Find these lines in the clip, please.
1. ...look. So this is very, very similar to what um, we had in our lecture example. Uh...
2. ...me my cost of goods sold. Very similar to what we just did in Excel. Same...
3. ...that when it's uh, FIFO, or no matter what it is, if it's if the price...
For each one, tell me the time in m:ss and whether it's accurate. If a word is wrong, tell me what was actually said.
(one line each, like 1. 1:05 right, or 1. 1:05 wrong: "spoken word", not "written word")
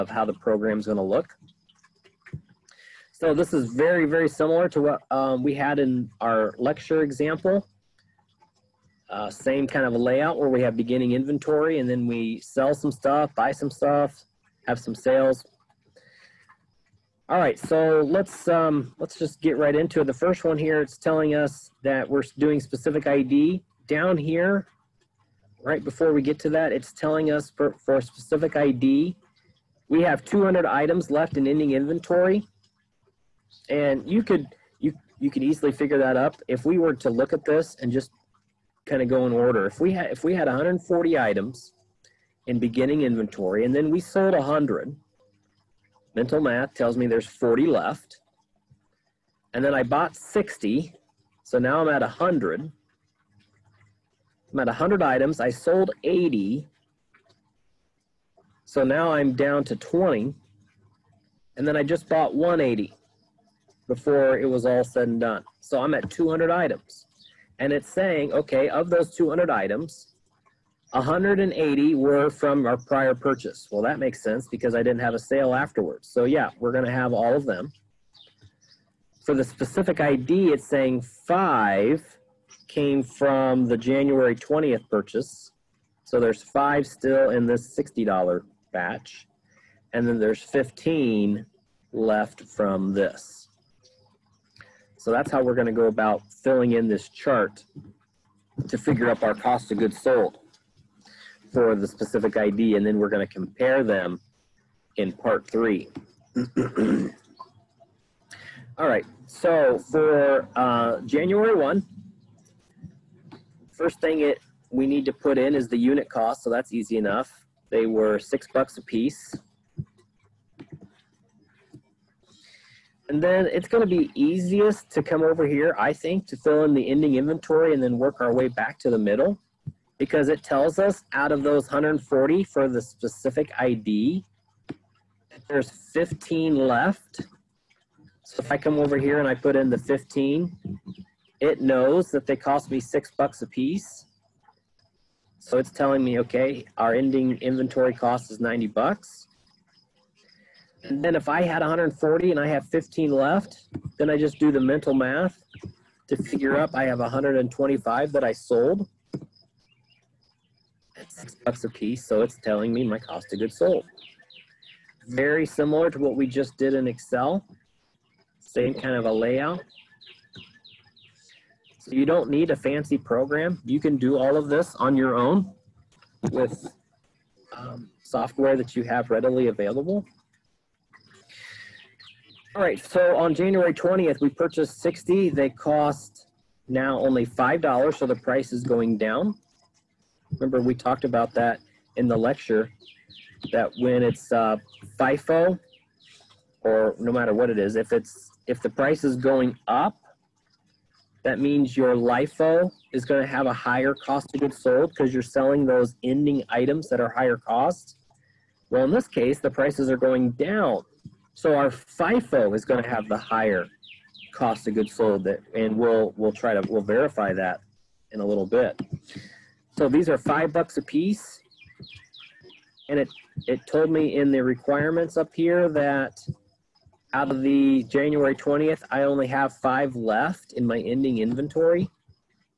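1. 0:01 right
2. 2:42 right
3. 3:13 right.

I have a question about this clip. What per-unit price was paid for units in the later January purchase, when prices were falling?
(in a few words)
$5.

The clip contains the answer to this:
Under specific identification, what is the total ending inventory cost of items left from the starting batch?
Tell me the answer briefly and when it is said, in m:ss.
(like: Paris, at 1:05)
$90, at 2:28.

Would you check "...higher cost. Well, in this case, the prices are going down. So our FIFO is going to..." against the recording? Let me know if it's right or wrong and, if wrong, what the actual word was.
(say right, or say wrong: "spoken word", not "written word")
right.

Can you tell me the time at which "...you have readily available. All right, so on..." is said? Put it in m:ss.
2:58.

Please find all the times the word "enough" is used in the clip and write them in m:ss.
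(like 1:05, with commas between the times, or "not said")
1:56.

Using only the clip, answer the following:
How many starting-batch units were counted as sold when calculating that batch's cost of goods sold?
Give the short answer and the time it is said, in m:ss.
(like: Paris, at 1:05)
125, at 2:36.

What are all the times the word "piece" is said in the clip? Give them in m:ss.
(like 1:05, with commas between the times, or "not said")
1:58, 2:23, 2:41, 3:40.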